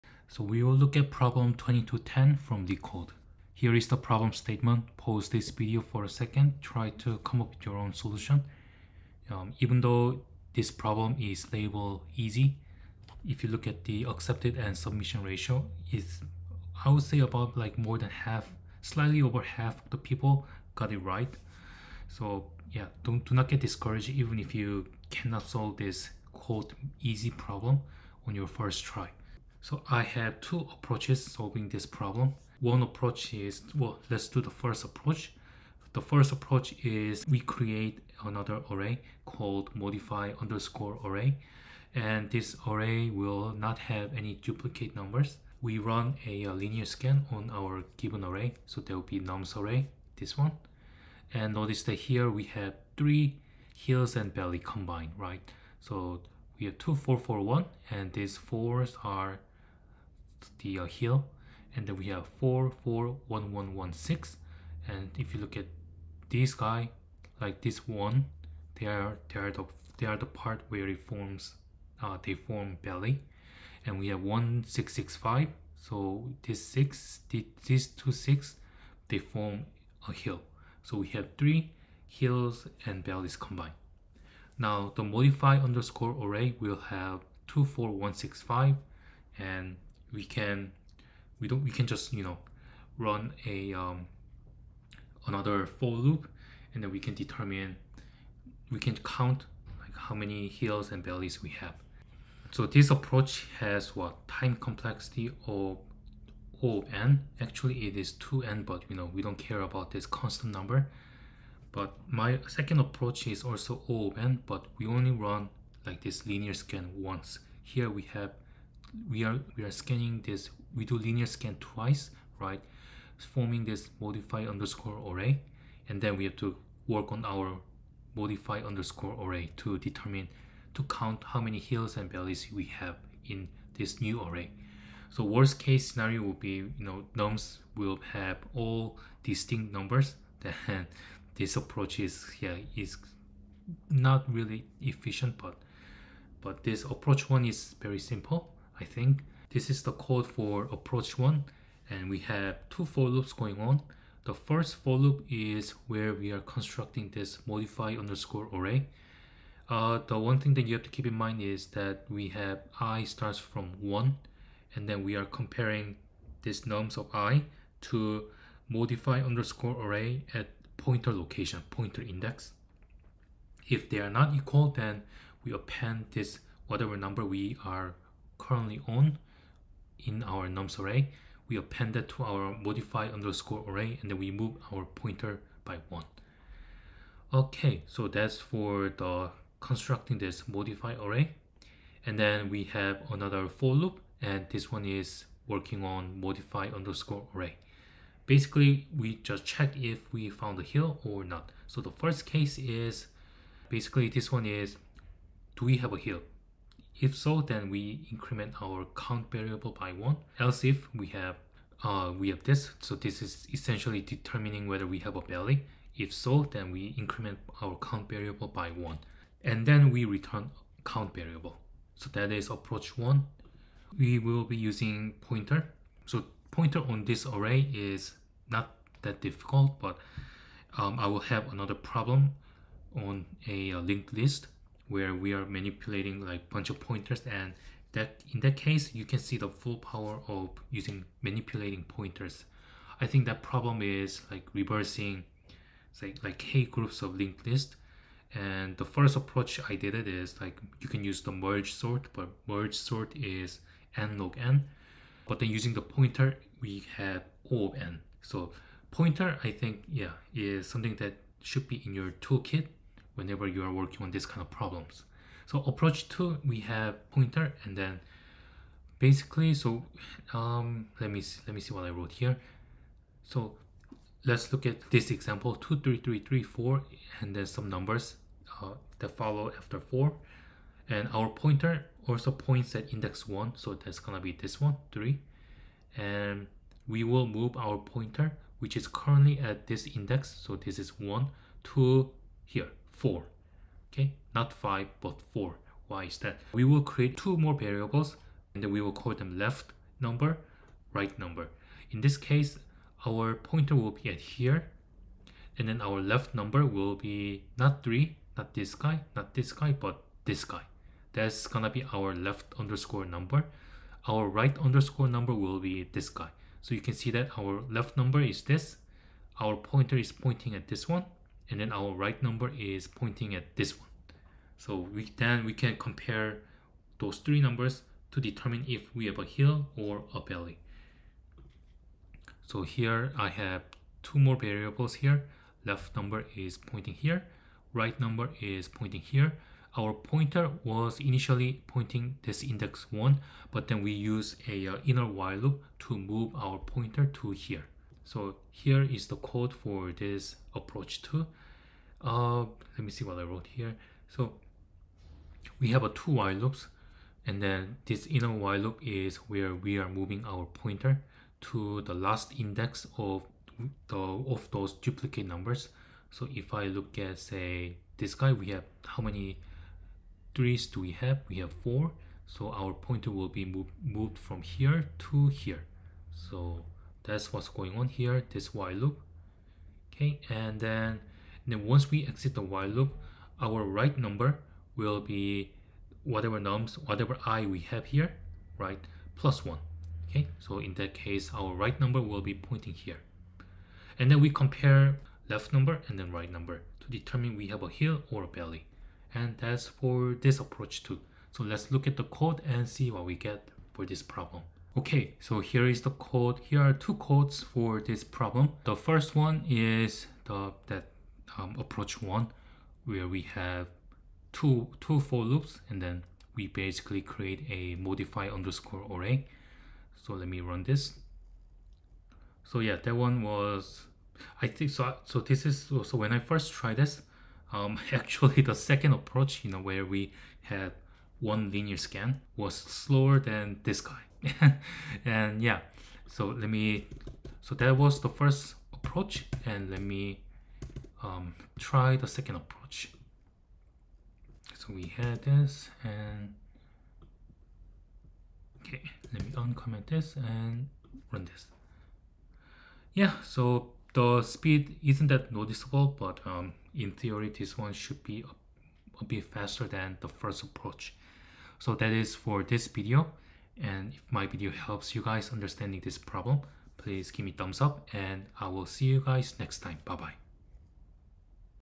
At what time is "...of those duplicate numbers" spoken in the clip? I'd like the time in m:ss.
6:03.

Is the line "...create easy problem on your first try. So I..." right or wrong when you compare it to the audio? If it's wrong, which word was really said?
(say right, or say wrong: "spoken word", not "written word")
wrong: "quote", not "create".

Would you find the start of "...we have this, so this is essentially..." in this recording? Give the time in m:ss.
3:32.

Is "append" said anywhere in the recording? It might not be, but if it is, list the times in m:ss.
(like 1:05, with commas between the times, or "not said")
2:55, 3:01.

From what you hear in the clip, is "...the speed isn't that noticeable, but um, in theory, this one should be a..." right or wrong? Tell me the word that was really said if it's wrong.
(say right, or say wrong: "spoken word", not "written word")
right.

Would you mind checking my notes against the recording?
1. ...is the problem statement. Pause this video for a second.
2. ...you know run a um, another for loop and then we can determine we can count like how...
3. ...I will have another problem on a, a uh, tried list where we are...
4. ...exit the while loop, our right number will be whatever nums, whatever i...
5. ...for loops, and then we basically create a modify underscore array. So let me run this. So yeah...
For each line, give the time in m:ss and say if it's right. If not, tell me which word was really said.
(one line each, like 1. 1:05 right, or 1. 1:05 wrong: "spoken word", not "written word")
1. 0:03 right
2. 1:32 right
3. 3:50 wrong: "linked", not "tried"
4. 6:22 right
5. 6:55 right.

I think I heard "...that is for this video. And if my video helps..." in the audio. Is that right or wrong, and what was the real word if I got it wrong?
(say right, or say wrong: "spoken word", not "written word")
right.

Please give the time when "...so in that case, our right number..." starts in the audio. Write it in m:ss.
6:30.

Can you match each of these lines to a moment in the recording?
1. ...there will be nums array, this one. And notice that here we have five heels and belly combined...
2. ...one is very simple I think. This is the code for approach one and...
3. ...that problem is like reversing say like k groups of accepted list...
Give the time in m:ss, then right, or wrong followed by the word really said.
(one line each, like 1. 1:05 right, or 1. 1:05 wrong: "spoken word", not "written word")
1. 0:48 wrong: "three", not "five"
2. 2:27 right
3. 4:03 wrong: "linked", not "accepted".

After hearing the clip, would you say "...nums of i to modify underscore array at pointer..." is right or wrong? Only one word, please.
right.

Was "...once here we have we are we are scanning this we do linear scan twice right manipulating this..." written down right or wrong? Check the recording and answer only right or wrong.
wrong.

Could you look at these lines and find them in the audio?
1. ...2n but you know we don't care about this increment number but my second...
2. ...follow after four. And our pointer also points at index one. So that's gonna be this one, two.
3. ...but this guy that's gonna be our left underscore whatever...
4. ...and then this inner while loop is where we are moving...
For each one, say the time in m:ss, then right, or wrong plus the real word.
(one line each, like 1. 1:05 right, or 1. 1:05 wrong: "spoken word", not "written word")
1. 1:48 wrong: "constant", not "increment"
2. 4:39 wrong: "three", not "two"
3. 5:09 wrong: "number", not "whatever"
4. 5:57 right.